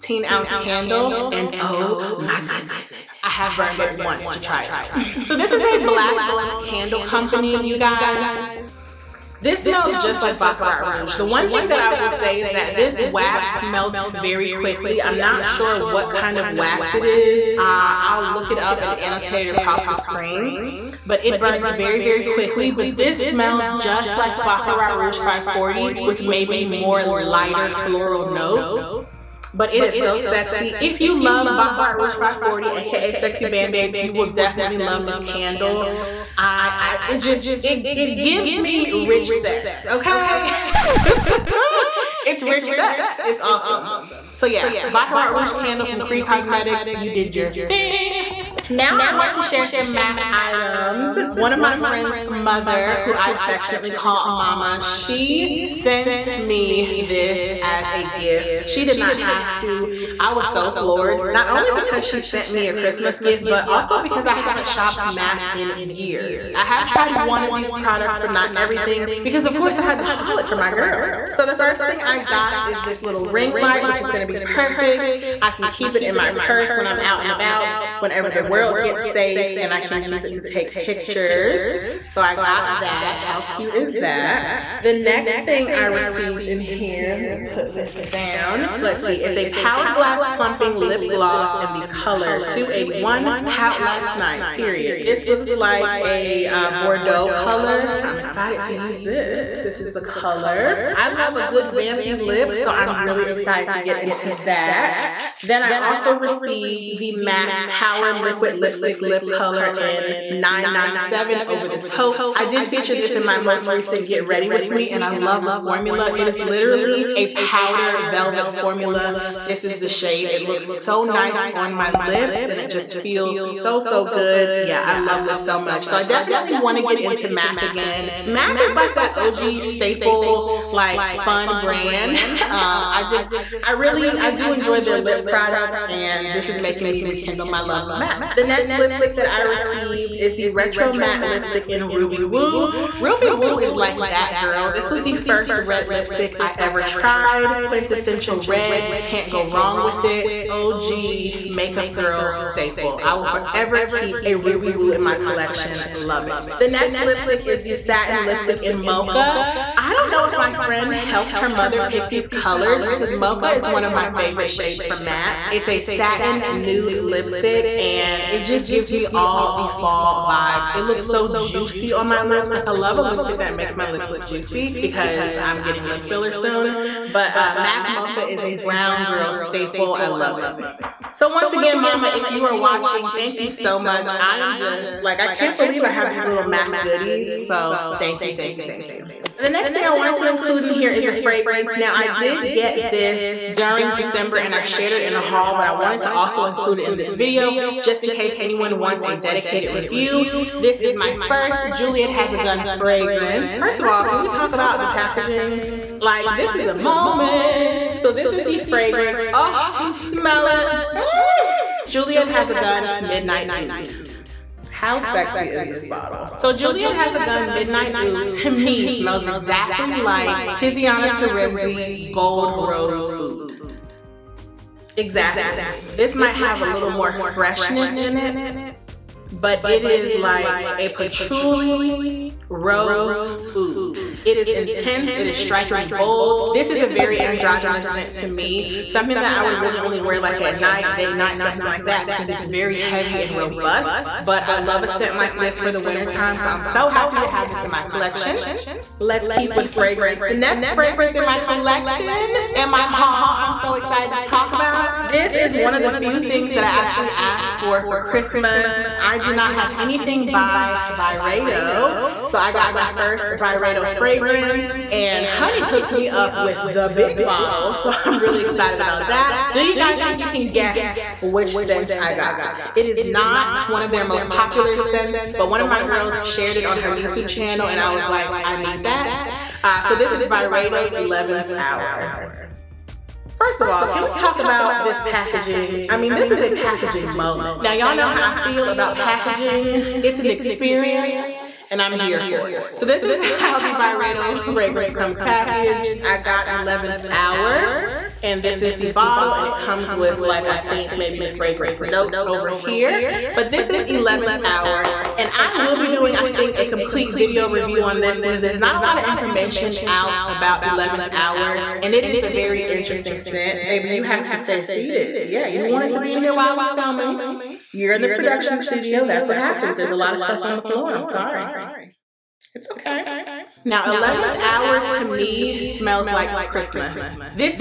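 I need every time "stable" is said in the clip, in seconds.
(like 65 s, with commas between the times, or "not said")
not said.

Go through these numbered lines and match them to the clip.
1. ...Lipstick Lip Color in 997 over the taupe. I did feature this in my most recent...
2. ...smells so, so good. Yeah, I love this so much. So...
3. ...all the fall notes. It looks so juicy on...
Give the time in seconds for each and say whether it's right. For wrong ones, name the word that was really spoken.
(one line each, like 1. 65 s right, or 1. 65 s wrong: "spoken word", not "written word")
1. 108 s right
2. 123 s wrong: "feels", not "smells"
3. 169 s wrong: "vibes", not "notes".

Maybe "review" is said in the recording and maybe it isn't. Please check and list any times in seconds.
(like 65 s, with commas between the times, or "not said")
199 s, 307 s.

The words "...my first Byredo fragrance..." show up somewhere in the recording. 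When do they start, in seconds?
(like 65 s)
262 s.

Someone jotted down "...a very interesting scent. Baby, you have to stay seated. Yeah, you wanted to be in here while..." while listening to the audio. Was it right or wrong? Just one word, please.
right.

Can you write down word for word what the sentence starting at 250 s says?
The next fragrance in my collection and my haul I'm so excited to talk about.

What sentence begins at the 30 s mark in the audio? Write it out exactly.
If you love Baccarat Rouge 540, aka Sexy Band-Aids, you will definitely love this candle.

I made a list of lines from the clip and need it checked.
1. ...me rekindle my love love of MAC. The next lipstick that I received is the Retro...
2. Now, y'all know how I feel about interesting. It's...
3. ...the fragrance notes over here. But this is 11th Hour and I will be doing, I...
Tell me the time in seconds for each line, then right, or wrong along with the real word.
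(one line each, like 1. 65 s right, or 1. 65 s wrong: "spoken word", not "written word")
1. 136 s right
2. 287 s wrong: "packaging", not "interesting"
3. 301 s right.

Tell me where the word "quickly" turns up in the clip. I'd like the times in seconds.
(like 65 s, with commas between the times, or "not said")
14 s, 22 s.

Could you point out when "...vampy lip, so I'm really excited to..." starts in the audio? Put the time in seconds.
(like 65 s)
101 s.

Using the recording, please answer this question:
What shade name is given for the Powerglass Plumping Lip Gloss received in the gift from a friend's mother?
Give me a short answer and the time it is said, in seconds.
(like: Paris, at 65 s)
Pout Last Night, at 93 s.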